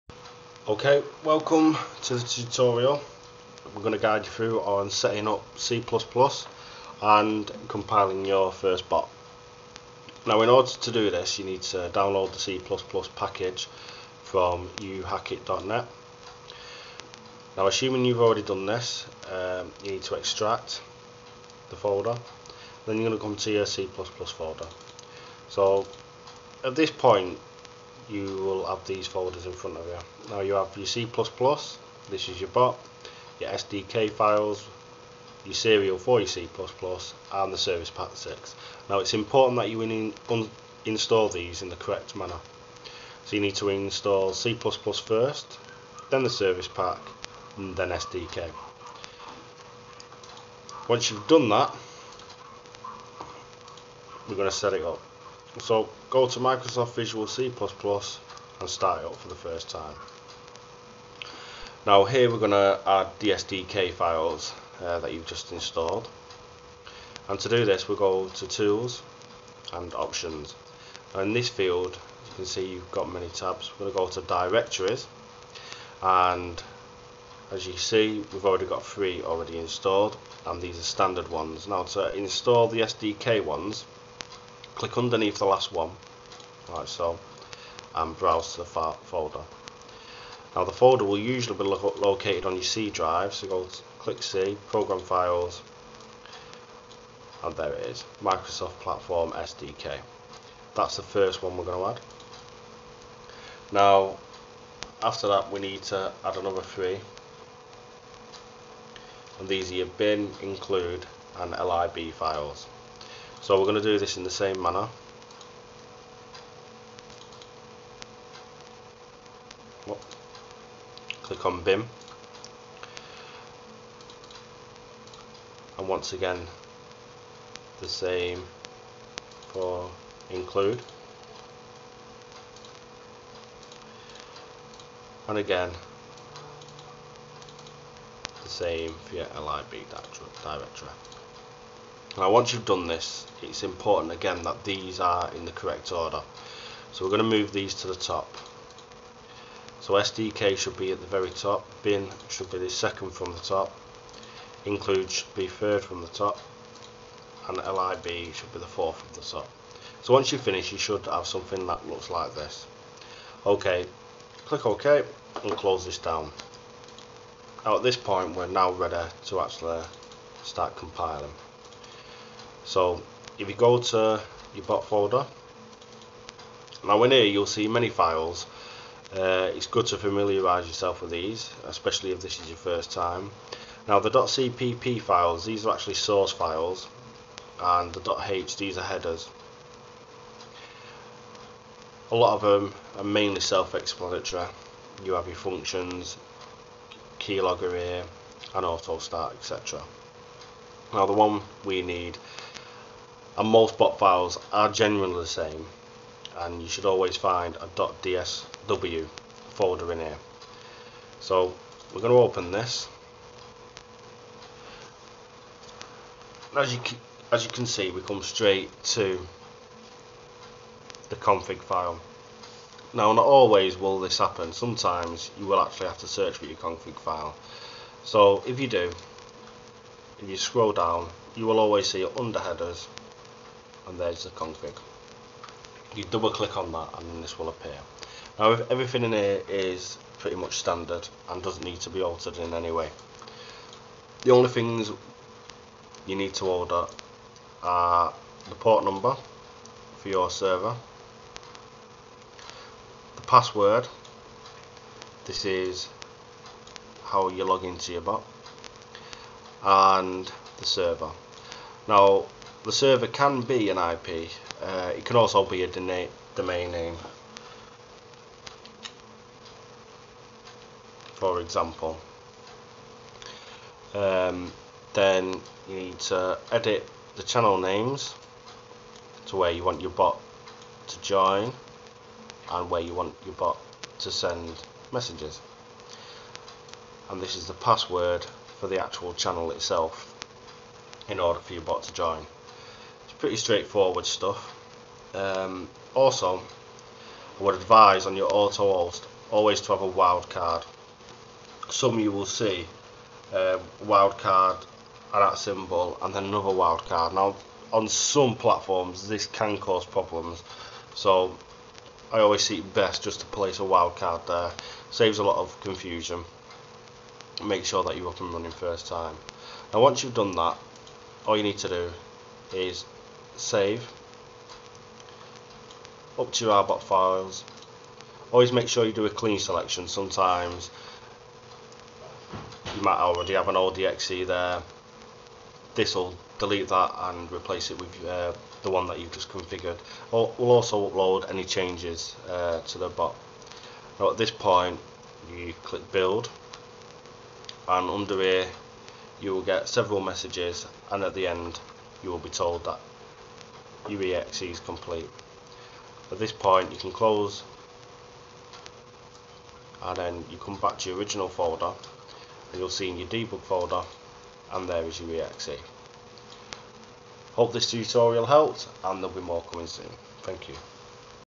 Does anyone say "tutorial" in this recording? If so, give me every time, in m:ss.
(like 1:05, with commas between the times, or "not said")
0:02, 6:07.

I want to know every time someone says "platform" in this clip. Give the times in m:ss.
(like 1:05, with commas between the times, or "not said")
1:38, 5:08.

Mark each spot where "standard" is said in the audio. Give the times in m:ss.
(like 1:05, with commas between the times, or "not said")
1:20, 4:00.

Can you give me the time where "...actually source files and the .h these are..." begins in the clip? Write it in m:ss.
3:05.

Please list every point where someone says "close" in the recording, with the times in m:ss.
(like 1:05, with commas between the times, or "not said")
2:45, 5:56.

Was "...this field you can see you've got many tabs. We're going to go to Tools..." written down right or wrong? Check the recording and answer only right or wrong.
wrong.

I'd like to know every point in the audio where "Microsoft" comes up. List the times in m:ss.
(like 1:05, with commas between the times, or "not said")
0:56, 1:38.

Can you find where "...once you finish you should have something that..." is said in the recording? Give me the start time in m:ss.
2:40.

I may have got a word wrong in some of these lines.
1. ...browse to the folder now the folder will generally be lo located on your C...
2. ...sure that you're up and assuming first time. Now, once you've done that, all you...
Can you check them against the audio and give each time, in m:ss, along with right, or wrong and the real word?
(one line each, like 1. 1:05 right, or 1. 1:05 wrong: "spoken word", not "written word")
1. 1:28 wrong: "usually", not "generally"
2. 5:17 wrong: "running", not "assuming".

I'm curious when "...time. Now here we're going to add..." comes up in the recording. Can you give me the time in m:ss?
0:59.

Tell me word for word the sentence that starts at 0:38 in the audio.
Now it's important that you in install these in the correct manner.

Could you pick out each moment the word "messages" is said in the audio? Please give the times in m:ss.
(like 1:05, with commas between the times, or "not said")
4:44, 5:49.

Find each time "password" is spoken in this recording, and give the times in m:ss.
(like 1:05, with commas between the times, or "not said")
4:13, 4:47.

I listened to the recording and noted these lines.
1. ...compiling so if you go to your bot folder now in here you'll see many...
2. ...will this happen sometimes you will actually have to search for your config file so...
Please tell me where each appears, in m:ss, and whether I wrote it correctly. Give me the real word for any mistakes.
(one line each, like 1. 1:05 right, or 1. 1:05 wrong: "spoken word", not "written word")
1. 2:50 right
2. 3:43 right.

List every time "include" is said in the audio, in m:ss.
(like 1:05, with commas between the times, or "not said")
1:50, 2:10, 2:34.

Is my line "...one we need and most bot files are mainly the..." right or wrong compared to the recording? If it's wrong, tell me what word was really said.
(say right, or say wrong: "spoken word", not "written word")
wrong: "generally", not "mainly".